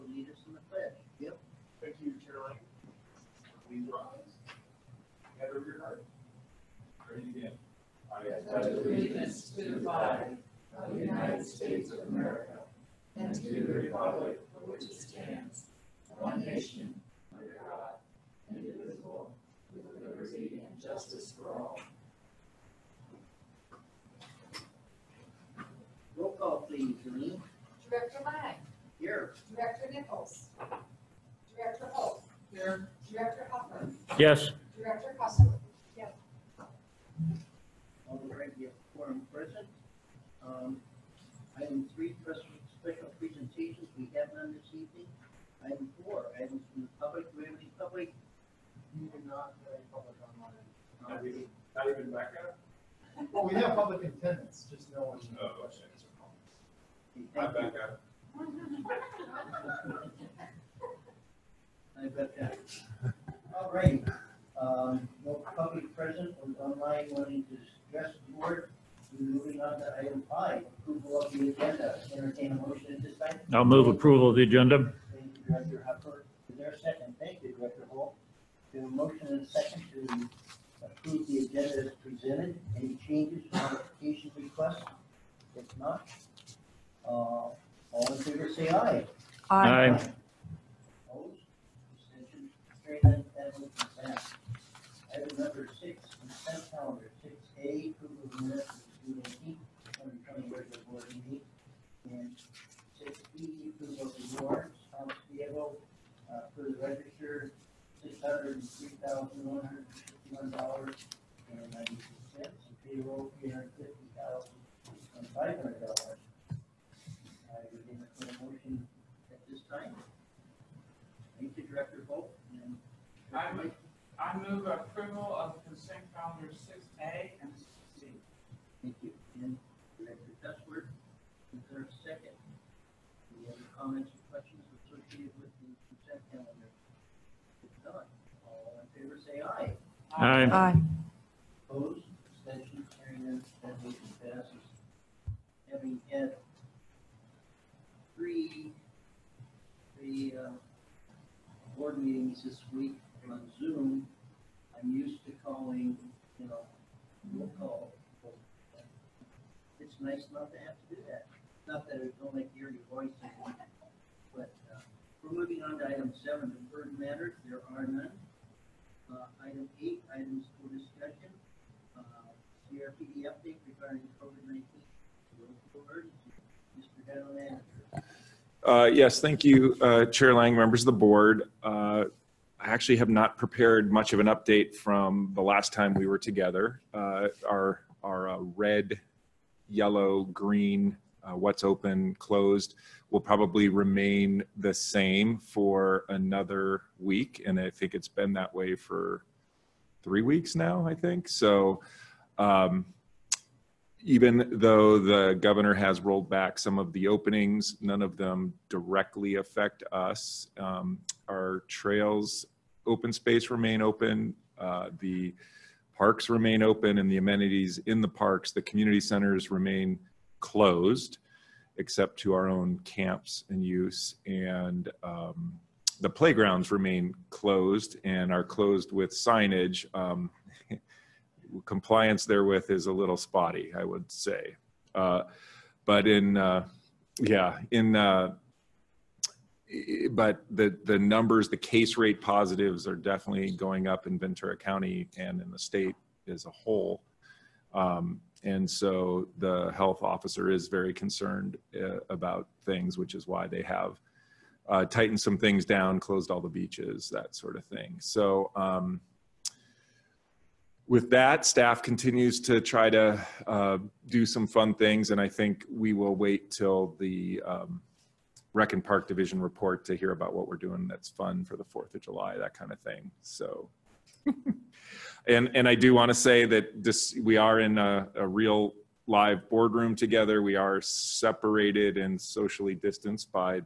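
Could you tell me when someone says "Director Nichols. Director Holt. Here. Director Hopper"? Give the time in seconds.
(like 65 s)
29 s.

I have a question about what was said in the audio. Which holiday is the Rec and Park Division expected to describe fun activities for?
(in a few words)
4th of July.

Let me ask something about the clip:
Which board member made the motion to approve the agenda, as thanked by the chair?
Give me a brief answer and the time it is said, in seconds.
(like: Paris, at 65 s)
Director Huffer, at 75 s.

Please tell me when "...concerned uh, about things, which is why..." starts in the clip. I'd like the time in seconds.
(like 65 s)
250 s.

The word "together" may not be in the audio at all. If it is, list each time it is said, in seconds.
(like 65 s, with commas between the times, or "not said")
186 s, 279 s.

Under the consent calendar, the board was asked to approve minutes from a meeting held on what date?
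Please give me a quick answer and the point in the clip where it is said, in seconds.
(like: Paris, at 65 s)
June 18, at 99 s.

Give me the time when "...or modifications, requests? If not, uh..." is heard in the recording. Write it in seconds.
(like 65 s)
83 s.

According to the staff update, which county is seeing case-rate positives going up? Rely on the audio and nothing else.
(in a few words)
Ventura County.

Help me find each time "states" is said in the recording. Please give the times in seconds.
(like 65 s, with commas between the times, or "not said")
11 s, 245 s.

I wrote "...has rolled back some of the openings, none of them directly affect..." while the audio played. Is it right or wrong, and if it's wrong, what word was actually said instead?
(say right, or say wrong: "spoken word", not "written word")
right.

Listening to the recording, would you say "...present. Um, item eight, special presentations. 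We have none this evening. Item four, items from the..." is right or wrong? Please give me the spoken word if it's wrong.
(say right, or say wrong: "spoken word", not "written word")
wrong: "three", not "eight".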